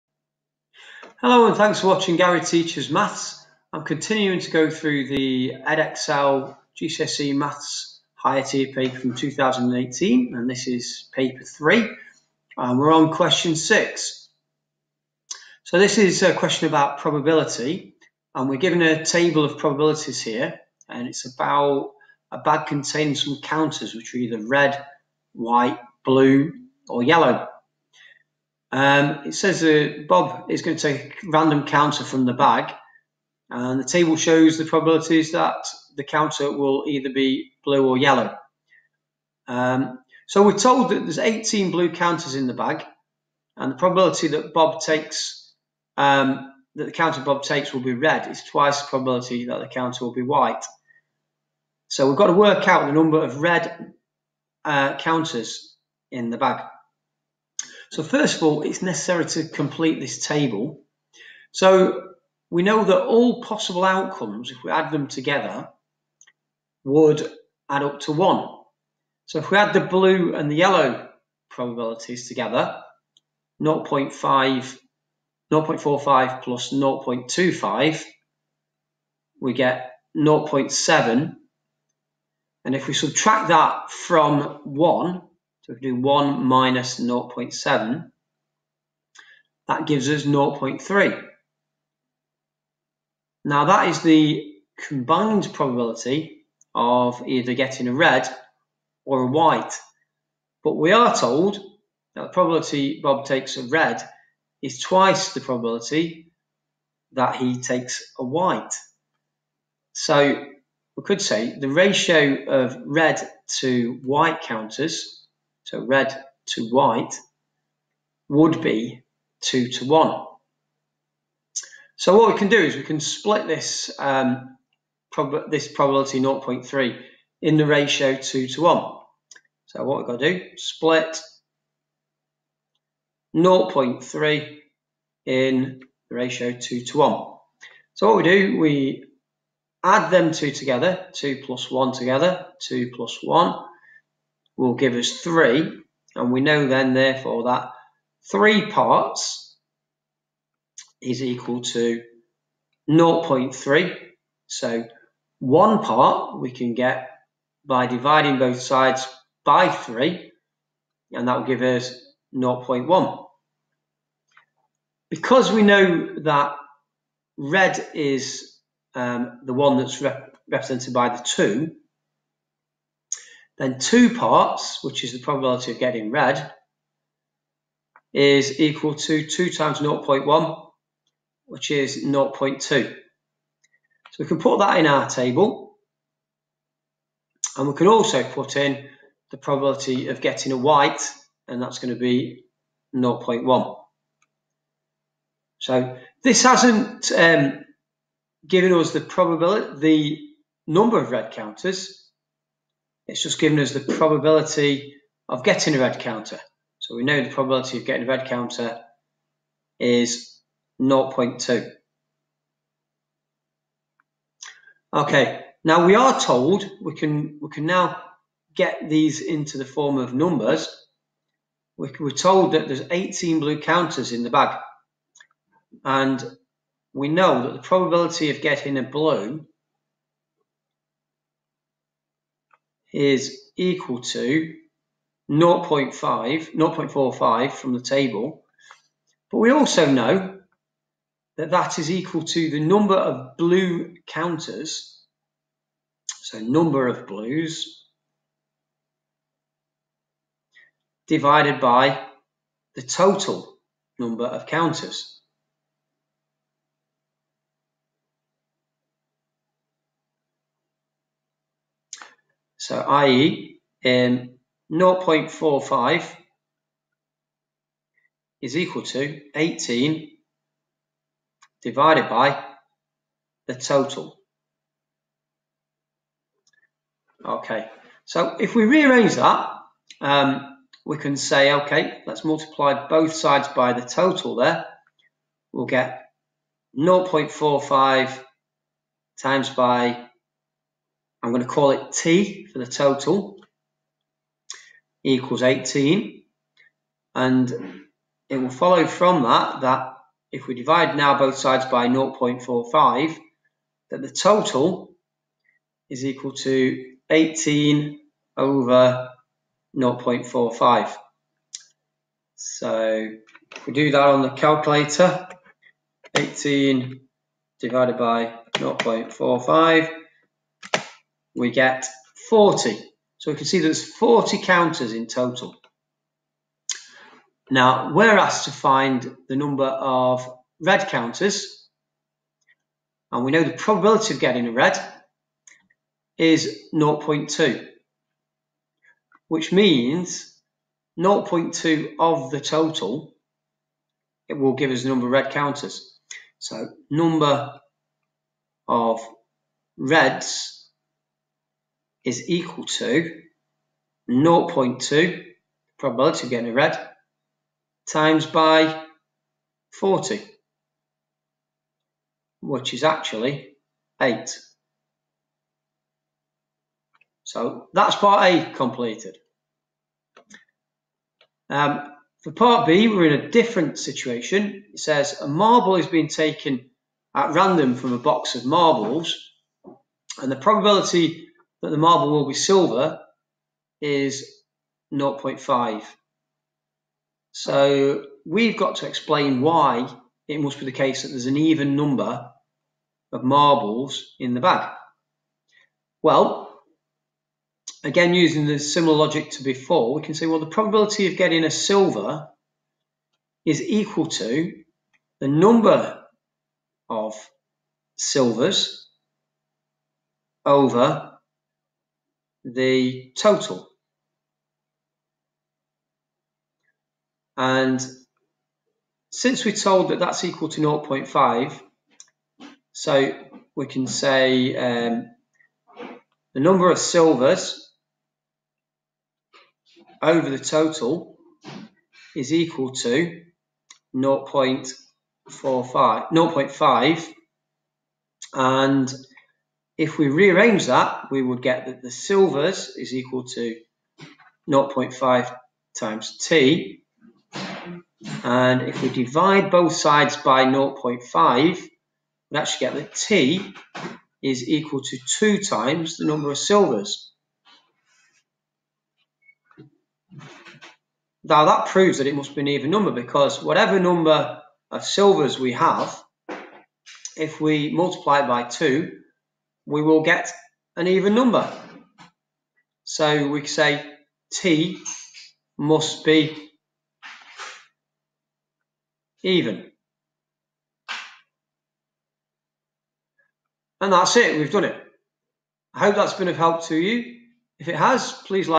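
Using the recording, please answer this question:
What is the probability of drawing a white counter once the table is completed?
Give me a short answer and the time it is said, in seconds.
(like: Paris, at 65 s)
0.1, at 191 s.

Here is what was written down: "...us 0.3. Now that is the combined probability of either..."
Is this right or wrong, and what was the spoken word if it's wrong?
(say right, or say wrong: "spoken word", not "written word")
right.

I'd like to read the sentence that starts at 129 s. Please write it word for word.
So what we've got to do, split 0.3 in the ratio 2 to 1.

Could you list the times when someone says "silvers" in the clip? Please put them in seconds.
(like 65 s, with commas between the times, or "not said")
382 s, 401 s, 407 s, 426 s, 441 s, 456 s, 464 s.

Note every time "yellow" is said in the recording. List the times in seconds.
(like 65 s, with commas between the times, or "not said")
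27 s, 37 s, 70 s.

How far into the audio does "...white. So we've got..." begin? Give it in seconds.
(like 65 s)
50 s.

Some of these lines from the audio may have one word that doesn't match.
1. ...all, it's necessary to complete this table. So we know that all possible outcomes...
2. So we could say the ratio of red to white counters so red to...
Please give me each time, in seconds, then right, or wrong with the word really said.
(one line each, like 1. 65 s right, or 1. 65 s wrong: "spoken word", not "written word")
1. 58 s right
2. 109 s right.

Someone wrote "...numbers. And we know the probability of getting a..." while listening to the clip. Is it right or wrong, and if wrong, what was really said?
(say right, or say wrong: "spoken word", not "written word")
wrong: "counters", not "numbers".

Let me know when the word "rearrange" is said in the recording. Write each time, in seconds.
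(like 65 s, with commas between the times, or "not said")
278 s, 440 s.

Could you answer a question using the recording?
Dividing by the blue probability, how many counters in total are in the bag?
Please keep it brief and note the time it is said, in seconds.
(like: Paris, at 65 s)
40, at 321 s.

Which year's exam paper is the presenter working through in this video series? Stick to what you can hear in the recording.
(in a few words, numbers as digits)
2018.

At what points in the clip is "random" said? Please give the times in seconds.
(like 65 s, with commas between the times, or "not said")
31 s, 377 s.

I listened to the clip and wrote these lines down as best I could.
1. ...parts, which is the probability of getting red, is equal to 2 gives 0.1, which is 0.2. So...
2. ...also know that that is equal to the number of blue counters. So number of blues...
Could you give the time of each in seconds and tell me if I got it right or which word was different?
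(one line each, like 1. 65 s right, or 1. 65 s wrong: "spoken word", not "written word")
1. 174 s wrong: "times", not "gives"
2. 239 s right.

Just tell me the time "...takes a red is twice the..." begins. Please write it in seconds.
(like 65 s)
103 s.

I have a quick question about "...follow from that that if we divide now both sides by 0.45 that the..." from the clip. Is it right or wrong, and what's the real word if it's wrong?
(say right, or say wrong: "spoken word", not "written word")
right.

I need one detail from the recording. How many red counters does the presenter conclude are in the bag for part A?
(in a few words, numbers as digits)
8.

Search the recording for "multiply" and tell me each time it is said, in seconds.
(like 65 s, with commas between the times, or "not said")
282 s, 467 s.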